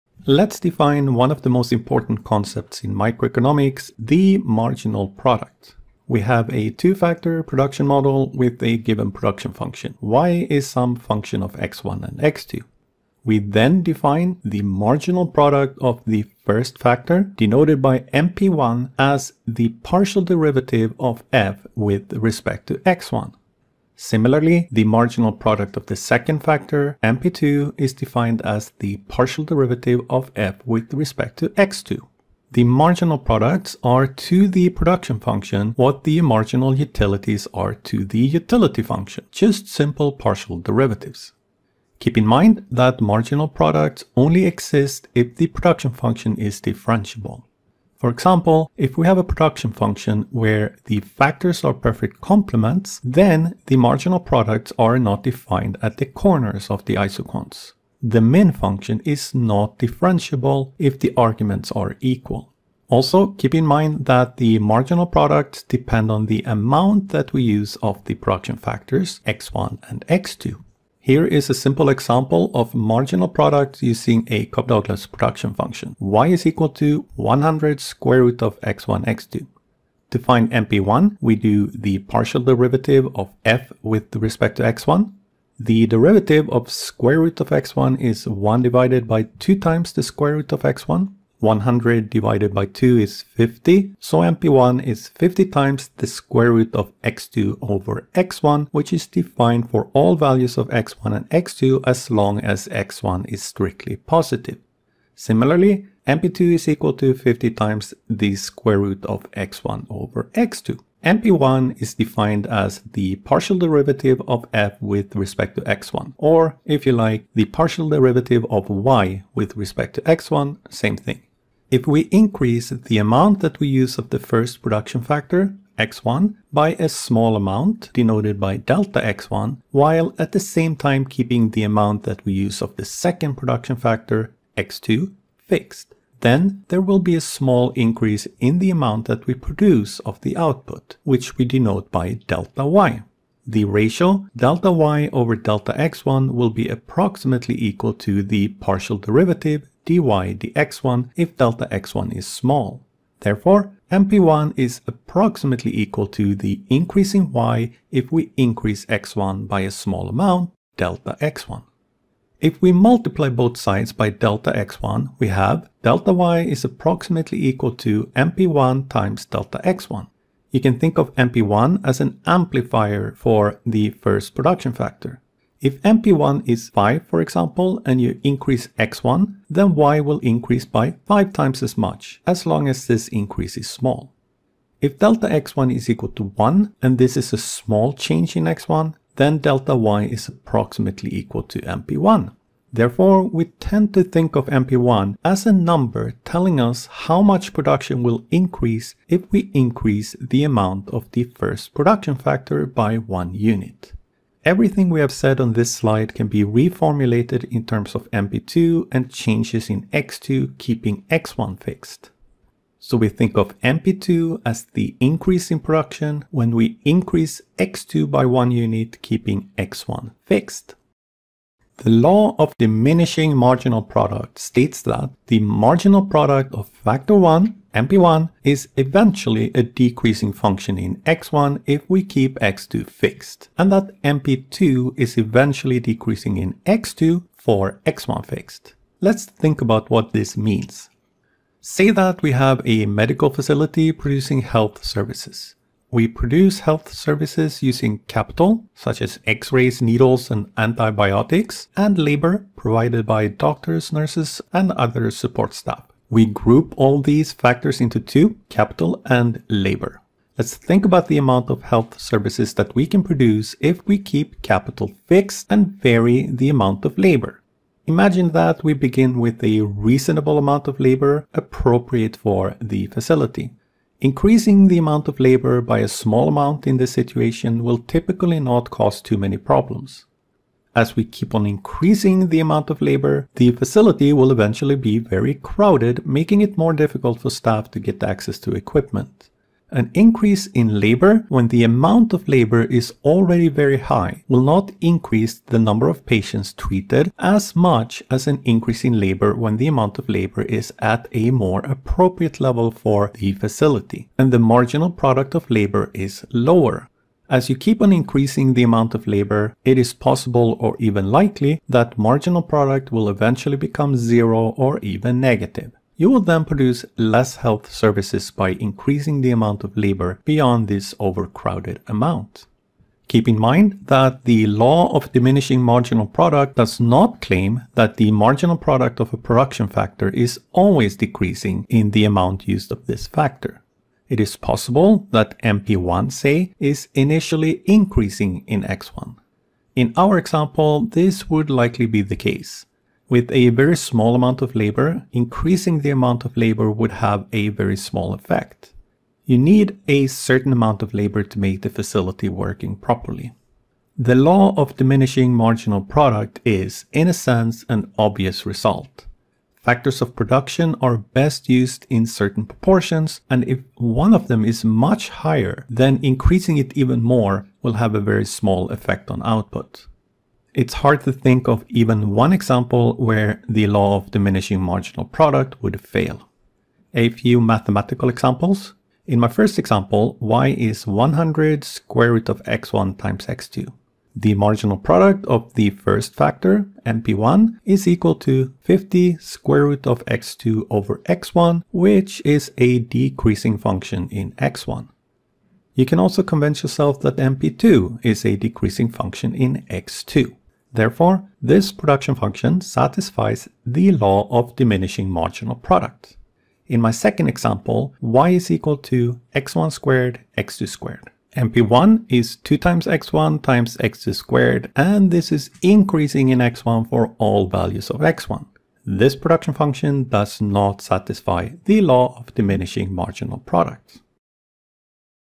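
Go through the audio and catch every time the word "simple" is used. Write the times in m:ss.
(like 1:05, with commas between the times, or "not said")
0:39, 1:11.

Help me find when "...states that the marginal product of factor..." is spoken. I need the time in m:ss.
3:44.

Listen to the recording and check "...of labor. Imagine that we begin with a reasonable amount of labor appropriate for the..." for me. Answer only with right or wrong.
right.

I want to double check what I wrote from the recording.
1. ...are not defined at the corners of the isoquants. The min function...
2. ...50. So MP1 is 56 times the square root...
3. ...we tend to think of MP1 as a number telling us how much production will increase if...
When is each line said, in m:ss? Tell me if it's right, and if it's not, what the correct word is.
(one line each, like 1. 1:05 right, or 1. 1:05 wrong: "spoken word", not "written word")
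1. 0:54 right
2. 1:33 wrong: "50", not "56"
3. 3:13 right.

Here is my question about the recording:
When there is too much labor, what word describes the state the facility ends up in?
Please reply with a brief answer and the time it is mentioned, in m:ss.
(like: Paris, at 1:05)
Very crowded, at 4:44.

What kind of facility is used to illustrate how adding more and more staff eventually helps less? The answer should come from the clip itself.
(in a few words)
Medical facility.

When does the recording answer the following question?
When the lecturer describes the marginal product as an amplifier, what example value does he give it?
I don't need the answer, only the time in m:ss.
2:55.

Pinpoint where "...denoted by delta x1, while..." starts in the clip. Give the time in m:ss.
2:07.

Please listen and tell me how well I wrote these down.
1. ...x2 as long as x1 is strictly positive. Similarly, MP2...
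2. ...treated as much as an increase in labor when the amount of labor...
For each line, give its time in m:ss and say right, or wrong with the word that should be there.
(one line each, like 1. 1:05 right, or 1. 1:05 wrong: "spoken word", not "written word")
1. 1:41 right
2. 4:56 right.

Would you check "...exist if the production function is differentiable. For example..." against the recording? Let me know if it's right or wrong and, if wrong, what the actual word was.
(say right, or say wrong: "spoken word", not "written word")
right.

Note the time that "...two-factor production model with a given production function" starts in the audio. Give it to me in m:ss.
0:06.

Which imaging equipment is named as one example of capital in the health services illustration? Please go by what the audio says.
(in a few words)
X-rays.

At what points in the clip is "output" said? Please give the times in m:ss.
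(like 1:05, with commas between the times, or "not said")
2:20, 6:09.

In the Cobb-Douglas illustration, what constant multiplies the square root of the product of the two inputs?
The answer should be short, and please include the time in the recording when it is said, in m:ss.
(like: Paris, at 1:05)
100, at 1:15.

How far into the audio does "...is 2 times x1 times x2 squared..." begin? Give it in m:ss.
6:52.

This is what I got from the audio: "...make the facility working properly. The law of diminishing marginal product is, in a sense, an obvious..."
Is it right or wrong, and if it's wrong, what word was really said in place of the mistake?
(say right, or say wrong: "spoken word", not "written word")
right.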